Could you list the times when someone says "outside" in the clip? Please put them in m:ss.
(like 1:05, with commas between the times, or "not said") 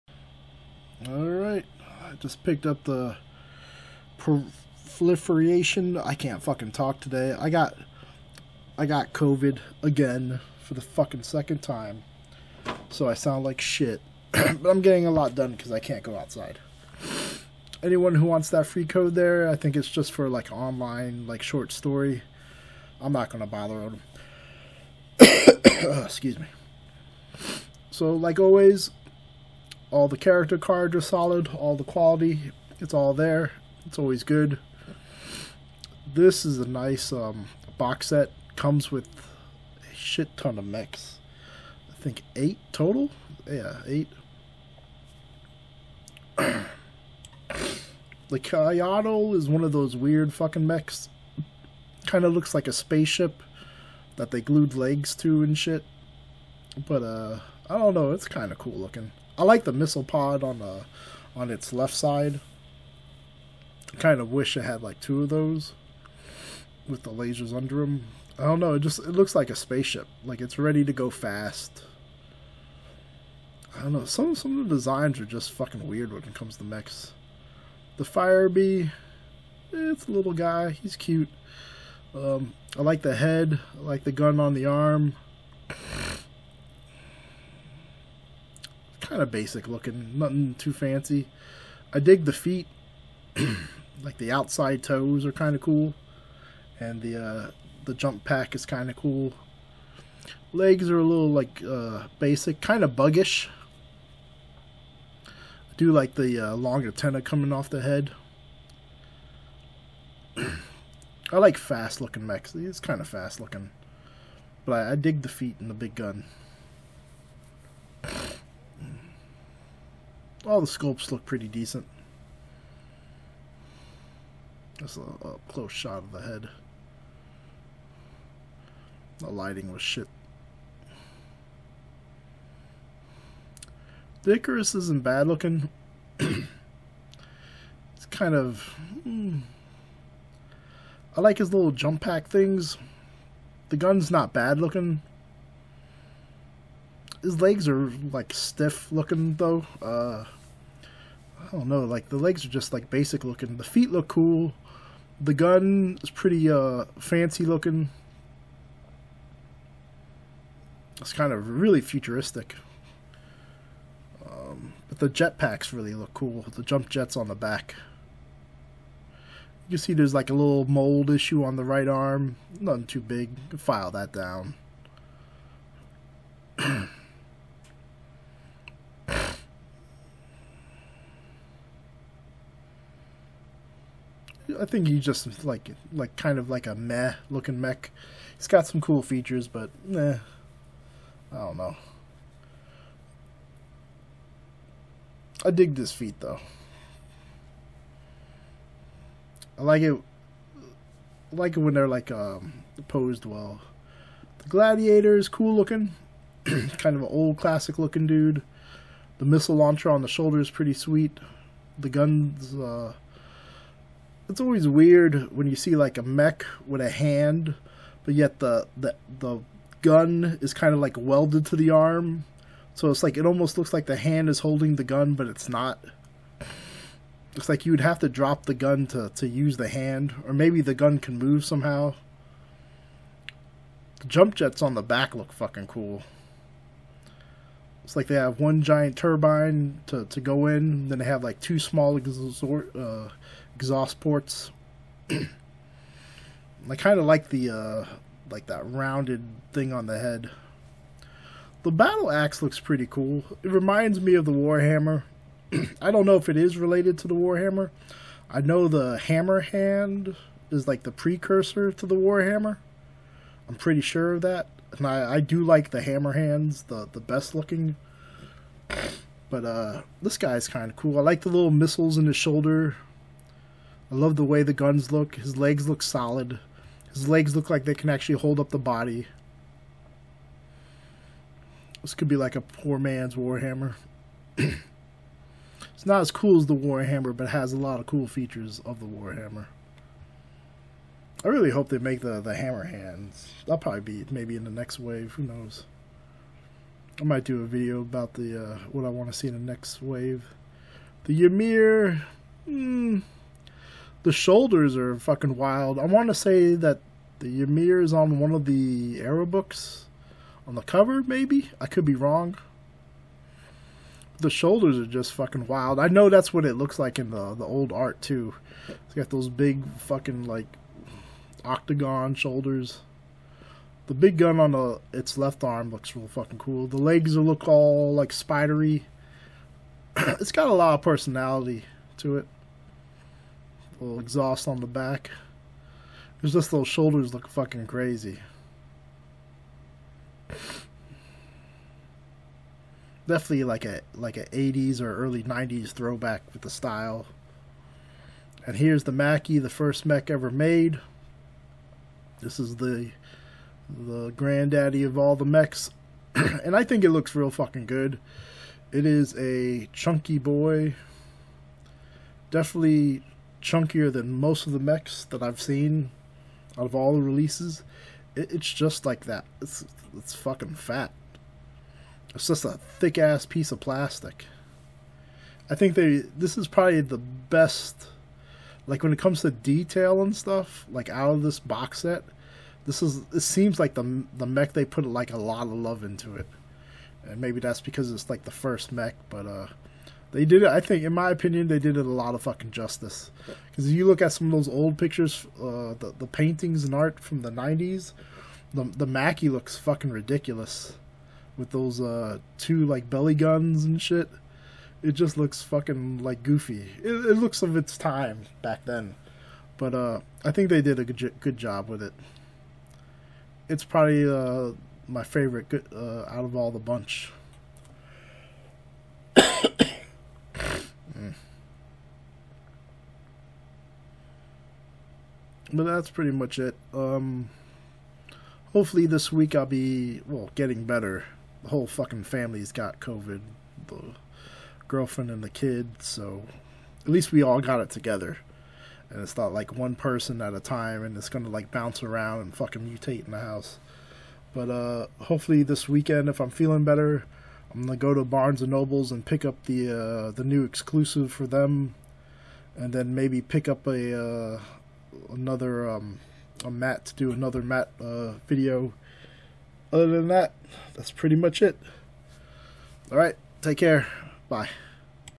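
0:16, 1:34.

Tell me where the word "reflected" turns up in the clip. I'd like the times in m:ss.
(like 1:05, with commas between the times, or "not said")
not said.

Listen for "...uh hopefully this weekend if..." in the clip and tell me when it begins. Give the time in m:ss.
7:24.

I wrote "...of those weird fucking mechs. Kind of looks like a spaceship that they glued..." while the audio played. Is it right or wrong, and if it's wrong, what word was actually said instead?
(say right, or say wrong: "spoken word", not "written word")
right.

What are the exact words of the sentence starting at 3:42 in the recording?
So it's like it almost looks like the hand is holding the gun, but it's not.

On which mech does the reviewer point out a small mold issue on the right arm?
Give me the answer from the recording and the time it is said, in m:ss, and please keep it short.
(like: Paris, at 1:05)
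Icarus, at 2:14.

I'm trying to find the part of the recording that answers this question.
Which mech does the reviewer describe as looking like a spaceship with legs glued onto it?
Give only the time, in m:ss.
0:46.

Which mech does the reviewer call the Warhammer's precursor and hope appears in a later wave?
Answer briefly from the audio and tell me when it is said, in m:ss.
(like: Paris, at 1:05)
hammer hand, at 4:18.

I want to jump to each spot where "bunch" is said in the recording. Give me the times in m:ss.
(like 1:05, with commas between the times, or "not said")
6:56.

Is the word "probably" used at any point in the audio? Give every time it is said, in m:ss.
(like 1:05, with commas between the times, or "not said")
4:53, 6:16, 6:53.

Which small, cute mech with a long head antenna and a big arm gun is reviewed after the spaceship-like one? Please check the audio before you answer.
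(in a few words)
Firebee.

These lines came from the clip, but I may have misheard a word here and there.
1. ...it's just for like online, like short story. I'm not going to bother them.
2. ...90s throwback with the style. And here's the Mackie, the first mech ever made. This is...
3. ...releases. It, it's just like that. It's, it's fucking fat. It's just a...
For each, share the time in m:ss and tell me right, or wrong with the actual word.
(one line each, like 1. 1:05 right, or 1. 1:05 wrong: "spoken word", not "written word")
1. 0:19 right
2. 5:45 right
3. 6:07 right.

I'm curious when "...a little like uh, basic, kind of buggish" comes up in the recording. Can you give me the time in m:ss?
1:40.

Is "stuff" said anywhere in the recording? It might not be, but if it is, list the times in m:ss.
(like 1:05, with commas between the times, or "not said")
6:20.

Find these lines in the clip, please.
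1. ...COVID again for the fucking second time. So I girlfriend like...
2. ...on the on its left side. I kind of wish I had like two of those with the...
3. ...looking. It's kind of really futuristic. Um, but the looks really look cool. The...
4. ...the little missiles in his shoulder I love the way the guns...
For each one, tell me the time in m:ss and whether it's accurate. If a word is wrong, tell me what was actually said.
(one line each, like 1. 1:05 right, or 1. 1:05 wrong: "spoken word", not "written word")
1. 0:09 wrong: "sound", not "girlfriend"
2. 1:00 right
3. 2:37 wrong: "jetpacks", not "looks"
4. 4:31 right.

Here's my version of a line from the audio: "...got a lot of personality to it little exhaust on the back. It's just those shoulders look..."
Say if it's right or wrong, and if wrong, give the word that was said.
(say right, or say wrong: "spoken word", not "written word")
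right.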